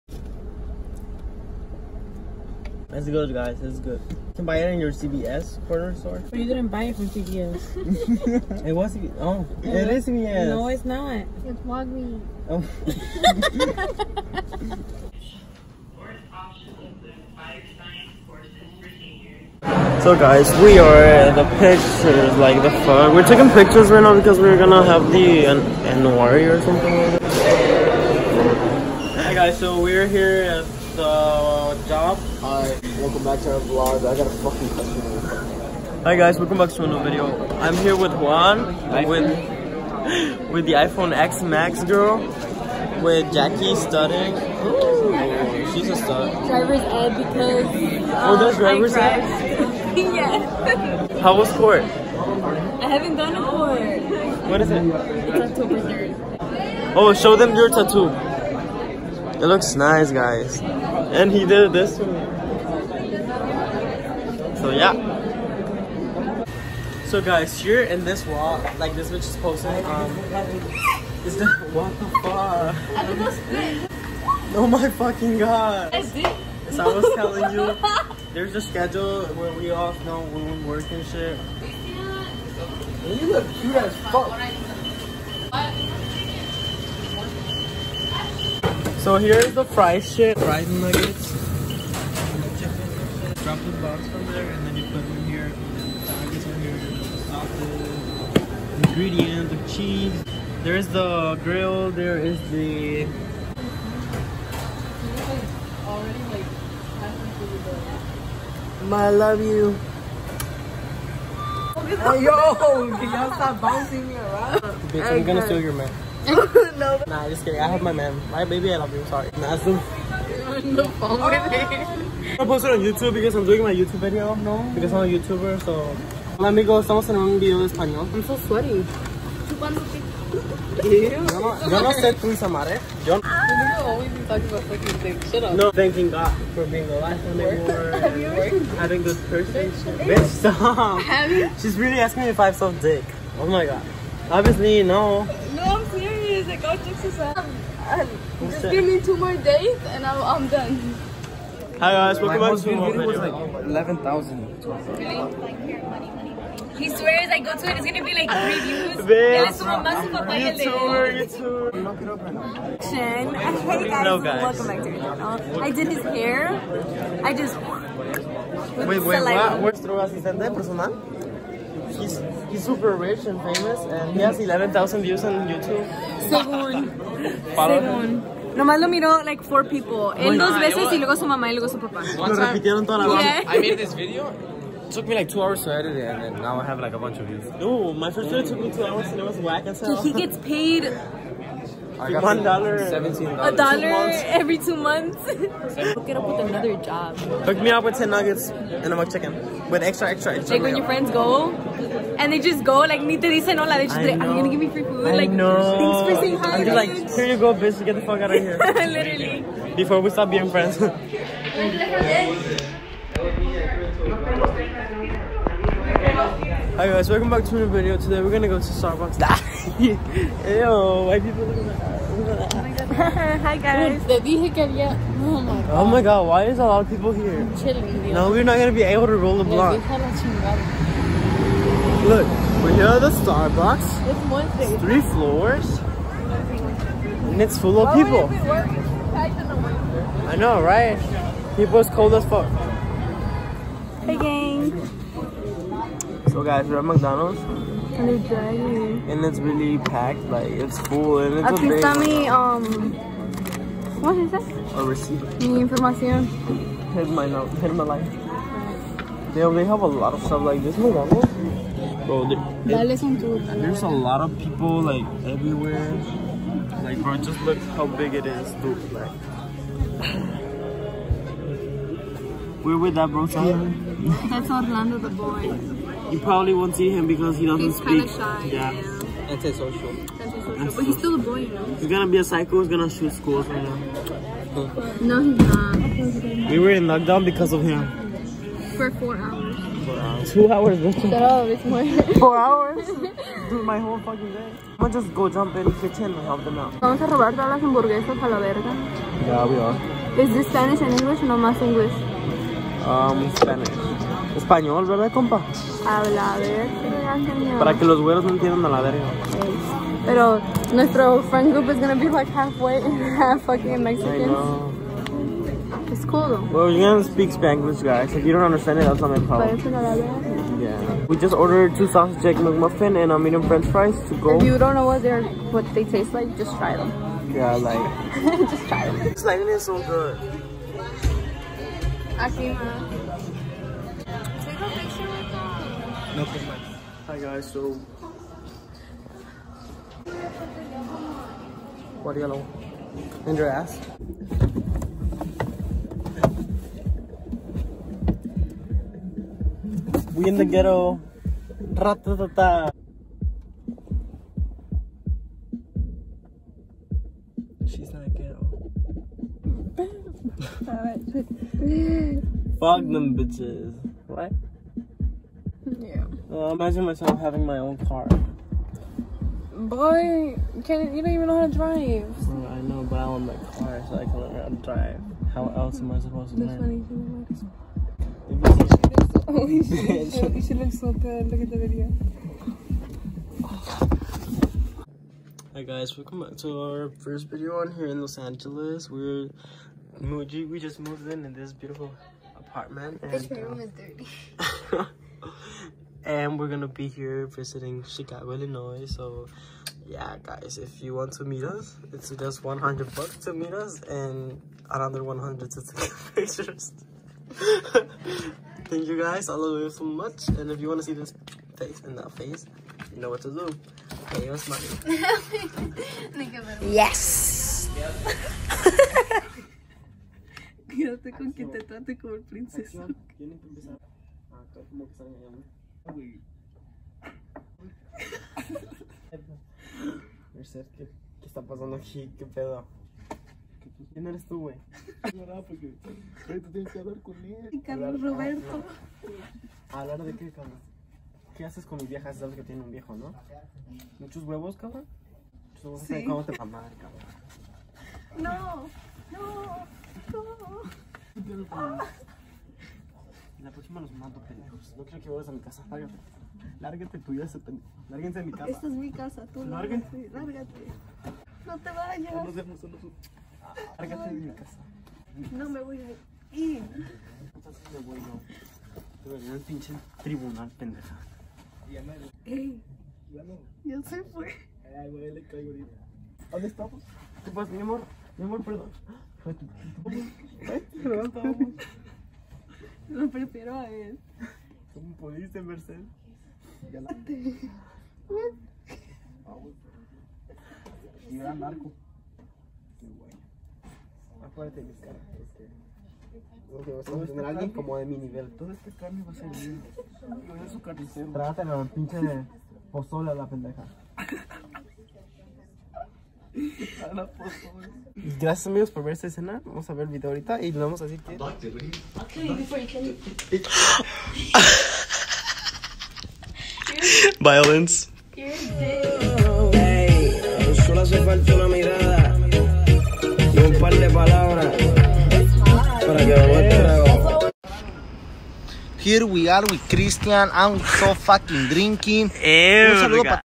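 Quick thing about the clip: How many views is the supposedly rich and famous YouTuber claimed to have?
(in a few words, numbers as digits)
11,000.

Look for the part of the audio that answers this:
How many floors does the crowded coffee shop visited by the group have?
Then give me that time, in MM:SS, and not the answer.
03:54.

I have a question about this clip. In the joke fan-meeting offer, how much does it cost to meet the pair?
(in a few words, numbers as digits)
$100.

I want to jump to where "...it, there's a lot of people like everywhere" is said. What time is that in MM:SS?
04:22.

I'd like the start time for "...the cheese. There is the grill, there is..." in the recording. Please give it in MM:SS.
01:39.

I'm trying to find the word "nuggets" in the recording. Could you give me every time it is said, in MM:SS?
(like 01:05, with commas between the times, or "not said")
01:30, 03:18.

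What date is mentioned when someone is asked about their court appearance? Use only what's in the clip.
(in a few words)
October 3rd.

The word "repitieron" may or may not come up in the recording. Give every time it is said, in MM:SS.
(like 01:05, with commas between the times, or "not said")
03:02.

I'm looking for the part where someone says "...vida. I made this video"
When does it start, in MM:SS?
03:03.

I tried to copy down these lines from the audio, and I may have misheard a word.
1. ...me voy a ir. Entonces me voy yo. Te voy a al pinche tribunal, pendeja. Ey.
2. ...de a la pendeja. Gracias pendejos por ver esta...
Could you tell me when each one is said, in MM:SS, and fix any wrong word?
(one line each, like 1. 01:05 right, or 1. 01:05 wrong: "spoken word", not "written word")
1. 07:45 right
2. 08:21 wrong: "amigos", not "pendejos".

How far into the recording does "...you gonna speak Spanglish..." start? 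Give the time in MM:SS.
05:16.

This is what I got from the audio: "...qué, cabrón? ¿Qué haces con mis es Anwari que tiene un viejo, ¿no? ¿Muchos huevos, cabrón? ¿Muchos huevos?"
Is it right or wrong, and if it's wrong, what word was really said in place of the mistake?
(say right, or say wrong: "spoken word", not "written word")
wrong: "Sabes", not "Anwari".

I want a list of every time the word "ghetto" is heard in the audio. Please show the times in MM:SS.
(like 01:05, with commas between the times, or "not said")
05:50, 05:58.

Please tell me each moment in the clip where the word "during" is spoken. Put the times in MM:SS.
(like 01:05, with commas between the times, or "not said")
not said.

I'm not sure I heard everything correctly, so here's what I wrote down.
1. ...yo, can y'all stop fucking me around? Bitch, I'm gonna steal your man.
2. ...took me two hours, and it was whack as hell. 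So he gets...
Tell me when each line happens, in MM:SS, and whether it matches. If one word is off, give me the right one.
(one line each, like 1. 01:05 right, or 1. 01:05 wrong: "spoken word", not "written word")
1. 01:52 wrong: "bouncing", not "fucking"
2. 03:08 right.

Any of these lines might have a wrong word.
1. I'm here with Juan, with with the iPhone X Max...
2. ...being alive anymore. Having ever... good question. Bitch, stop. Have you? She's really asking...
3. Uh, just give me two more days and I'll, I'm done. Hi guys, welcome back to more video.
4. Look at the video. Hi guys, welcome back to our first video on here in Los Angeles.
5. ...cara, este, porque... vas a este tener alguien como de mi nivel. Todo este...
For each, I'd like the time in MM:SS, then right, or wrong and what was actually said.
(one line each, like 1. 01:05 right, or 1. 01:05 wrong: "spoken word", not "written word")
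1. 00:37 right
2. 02:16 wrong: "person", not "question"
3. 02:27 right
4. 06:21 right
5. 08:14 right.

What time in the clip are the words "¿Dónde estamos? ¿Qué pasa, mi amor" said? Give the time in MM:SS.
07:56.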